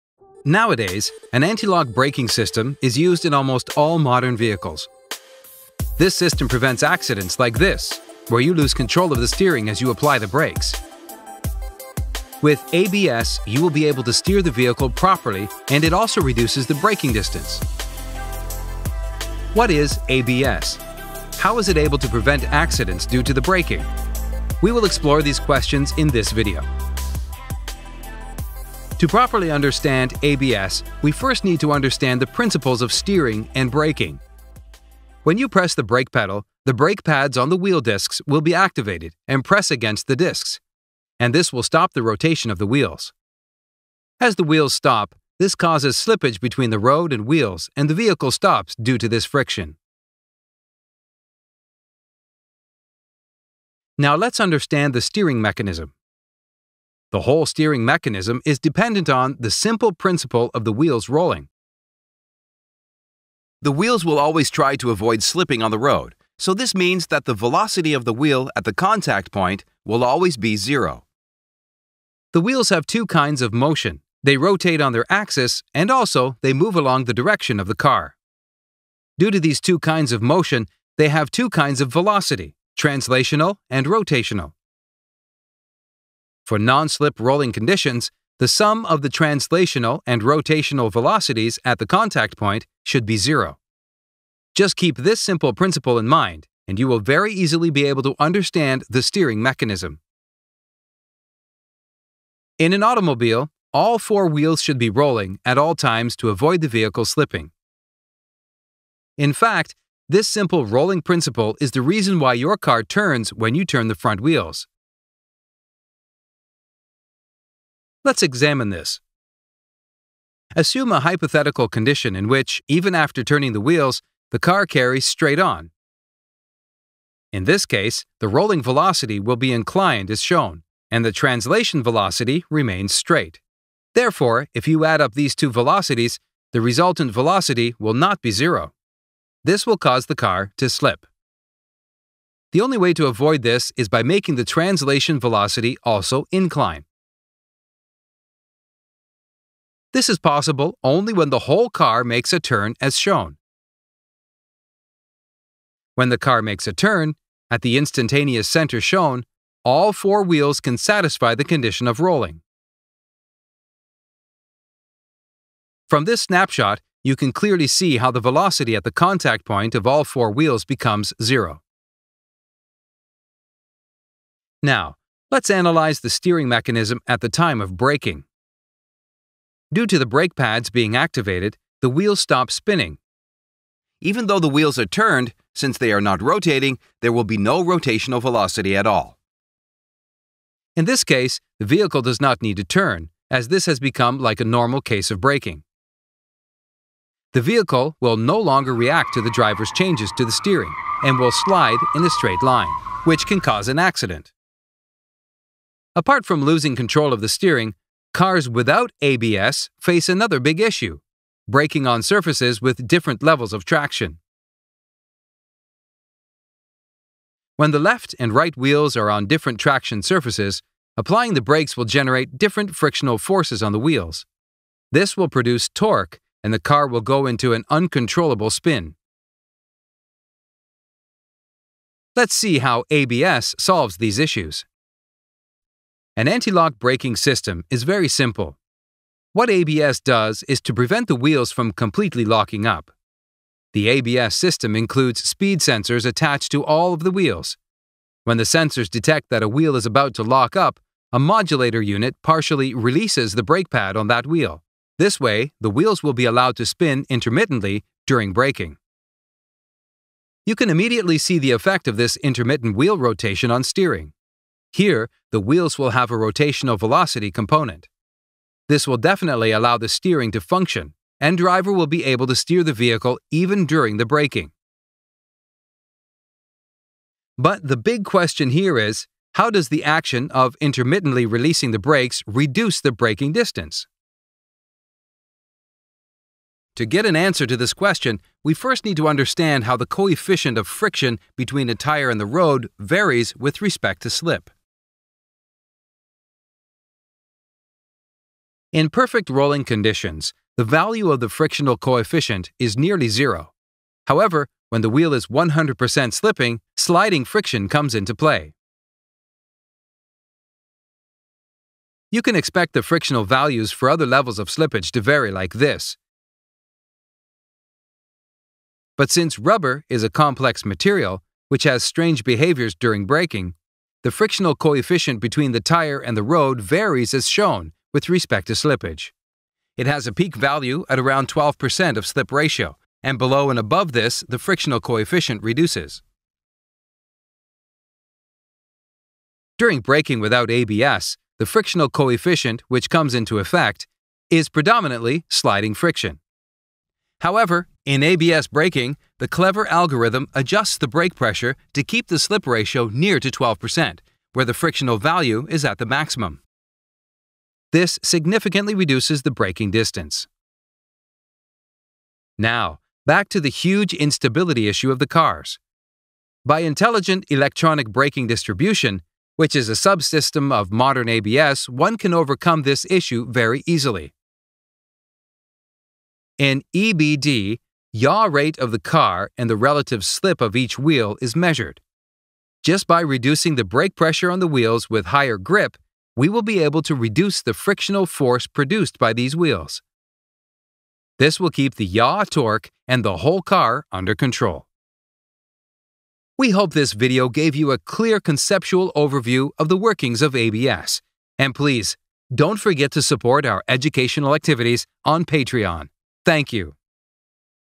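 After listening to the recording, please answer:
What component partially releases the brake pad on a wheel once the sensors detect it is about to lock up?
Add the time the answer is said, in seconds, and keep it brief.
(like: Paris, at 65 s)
A modulator unit, at 251 s.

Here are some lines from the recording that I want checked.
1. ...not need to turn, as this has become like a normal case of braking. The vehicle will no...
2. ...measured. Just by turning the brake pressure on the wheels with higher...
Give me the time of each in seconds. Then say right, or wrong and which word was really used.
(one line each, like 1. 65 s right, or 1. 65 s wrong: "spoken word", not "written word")
1. 192 s right
2. 381 s wrong: "reducing", not "turning".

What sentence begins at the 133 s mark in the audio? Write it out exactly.
Therefore, if you add up these two velocities, the resultant velocity will not be zero.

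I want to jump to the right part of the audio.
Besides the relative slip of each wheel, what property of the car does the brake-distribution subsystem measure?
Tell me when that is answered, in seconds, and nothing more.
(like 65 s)
377 s.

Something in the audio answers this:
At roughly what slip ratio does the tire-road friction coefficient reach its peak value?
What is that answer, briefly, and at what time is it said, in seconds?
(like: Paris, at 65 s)
12%, at 331 s.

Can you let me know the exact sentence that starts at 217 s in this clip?
When the left and right wheels are on different traction surfaces, applying the brakes will generate different frictional forces on the wheels.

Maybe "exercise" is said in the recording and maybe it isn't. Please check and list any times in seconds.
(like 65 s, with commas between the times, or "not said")
not said.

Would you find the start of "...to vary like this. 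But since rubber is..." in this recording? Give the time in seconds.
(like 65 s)
314 s.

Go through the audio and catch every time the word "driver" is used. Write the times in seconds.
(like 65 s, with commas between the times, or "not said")
199 s, 271 s.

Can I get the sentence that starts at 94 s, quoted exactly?
Just keep this simple principle in mind, and you will very easily be able to understand the steering mechanism.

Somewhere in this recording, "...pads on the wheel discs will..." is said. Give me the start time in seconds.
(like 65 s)
37 s.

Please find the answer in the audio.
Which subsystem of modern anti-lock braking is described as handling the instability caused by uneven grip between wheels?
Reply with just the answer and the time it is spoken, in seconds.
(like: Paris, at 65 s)
Electronic braking distribution, at 367 s.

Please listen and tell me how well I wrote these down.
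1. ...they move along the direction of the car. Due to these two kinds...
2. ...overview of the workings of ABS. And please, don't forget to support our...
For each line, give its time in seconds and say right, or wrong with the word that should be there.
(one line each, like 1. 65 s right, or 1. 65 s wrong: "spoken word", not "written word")
1. 76 s right
2. 398 s right.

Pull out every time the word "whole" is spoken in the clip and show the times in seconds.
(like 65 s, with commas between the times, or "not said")
57 s, 151 s, 393 s.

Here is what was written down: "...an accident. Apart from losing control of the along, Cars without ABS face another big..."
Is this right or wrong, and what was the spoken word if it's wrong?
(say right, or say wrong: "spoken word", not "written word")
wrong: "steering", not "along".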